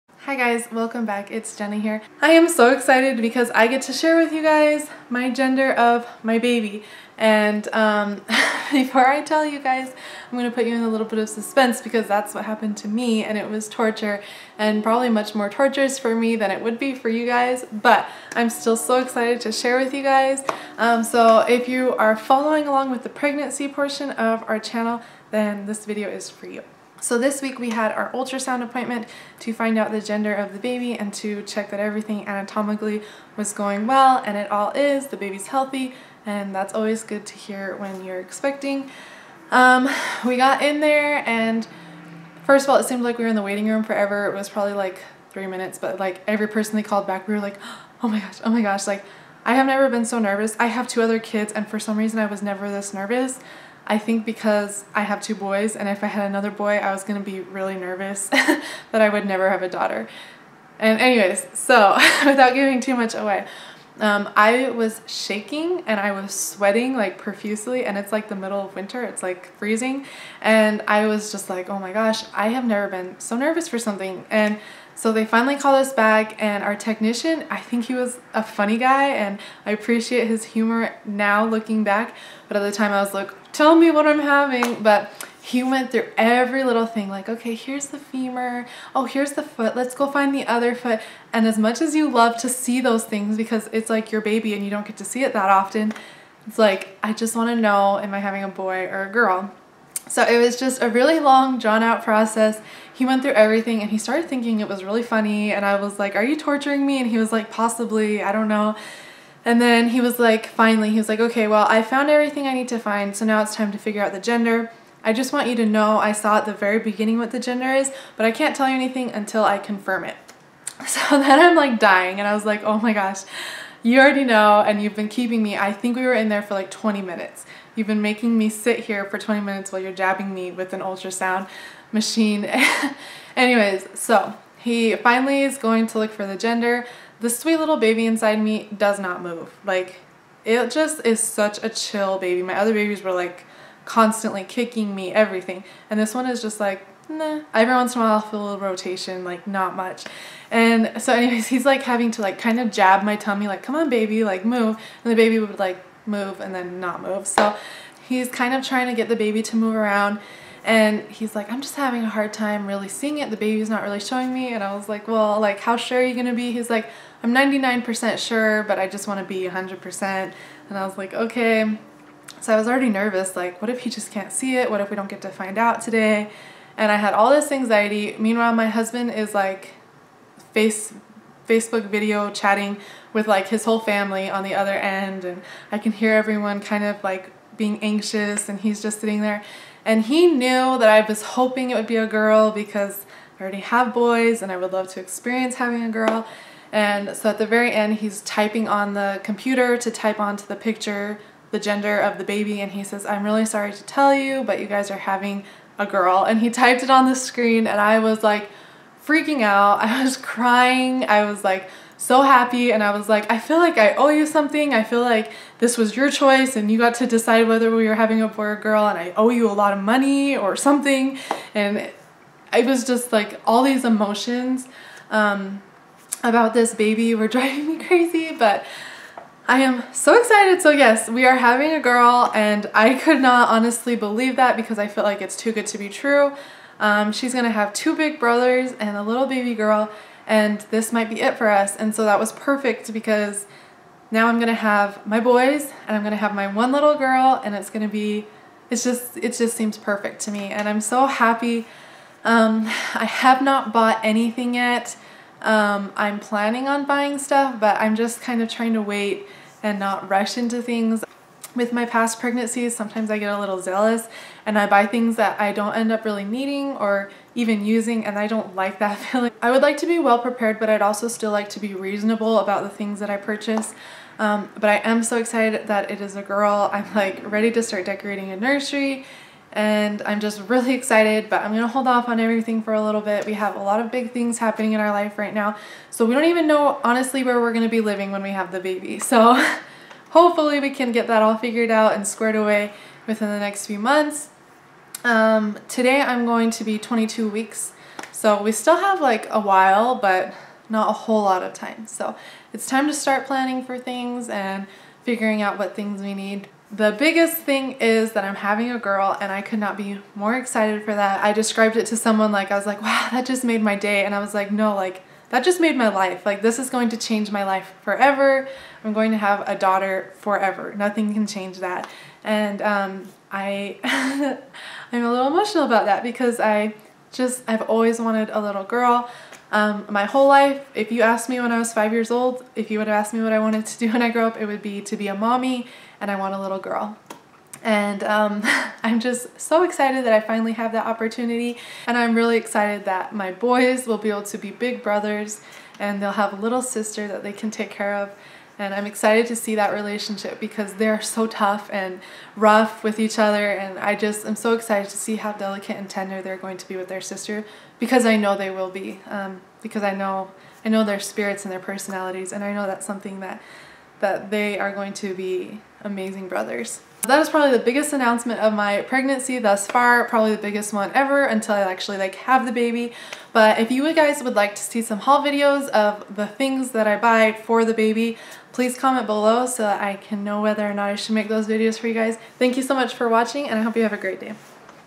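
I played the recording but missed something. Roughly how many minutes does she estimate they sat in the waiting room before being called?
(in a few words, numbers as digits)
3 minutes.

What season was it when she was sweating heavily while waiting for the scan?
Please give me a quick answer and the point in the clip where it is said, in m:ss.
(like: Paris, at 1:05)
Winter, at 1:08.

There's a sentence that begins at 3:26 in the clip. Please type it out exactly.
And he typed it on the screen, and I was like freaking out.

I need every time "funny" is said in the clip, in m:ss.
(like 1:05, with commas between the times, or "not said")
1:18, 1:45.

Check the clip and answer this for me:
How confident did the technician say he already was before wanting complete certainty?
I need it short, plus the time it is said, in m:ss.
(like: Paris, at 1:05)
99%, at 2:47.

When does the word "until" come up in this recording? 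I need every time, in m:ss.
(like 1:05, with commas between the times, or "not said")
1:59, 6:11.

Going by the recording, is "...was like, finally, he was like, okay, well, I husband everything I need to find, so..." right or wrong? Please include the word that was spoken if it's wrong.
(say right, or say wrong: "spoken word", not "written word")
wrong: "found", not "husband".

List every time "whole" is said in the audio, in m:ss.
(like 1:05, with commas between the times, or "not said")
3:03, 5:00, 5:30.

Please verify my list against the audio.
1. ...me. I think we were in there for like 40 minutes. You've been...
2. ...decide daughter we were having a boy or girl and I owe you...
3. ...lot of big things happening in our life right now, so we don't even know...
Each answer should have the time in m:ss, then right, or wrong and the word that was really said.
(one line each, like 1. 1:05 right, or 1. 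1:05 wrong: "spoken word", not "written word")
1. 2:05 wrong: "20", not "40"
2. 3:37 wrong: "whether", not "daughter"
3. 4:43 right.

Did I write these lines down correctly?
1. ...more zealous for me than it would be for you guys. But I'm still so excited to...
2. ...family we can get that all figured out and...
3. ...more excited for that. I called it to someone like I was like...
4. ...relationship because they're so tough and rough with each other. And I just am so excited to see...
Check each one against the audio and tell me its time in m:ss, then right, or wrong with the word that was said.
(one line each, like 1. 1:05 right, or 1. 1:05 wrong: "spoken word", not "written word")
1. 0:15 wrong: "torturous", not "zealous"
2. 4:50 wrong: "hopefully", not "family"
3. 5:10 wrong: "described", not "called"
4. 5:49 right.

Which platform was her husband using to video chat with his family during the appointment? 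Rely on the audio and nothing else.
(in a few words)
Facebook.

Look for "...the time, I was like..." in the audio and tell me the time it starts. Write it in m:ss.
1:22.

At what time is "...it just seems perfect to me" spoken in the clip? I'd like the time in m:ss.
4:09.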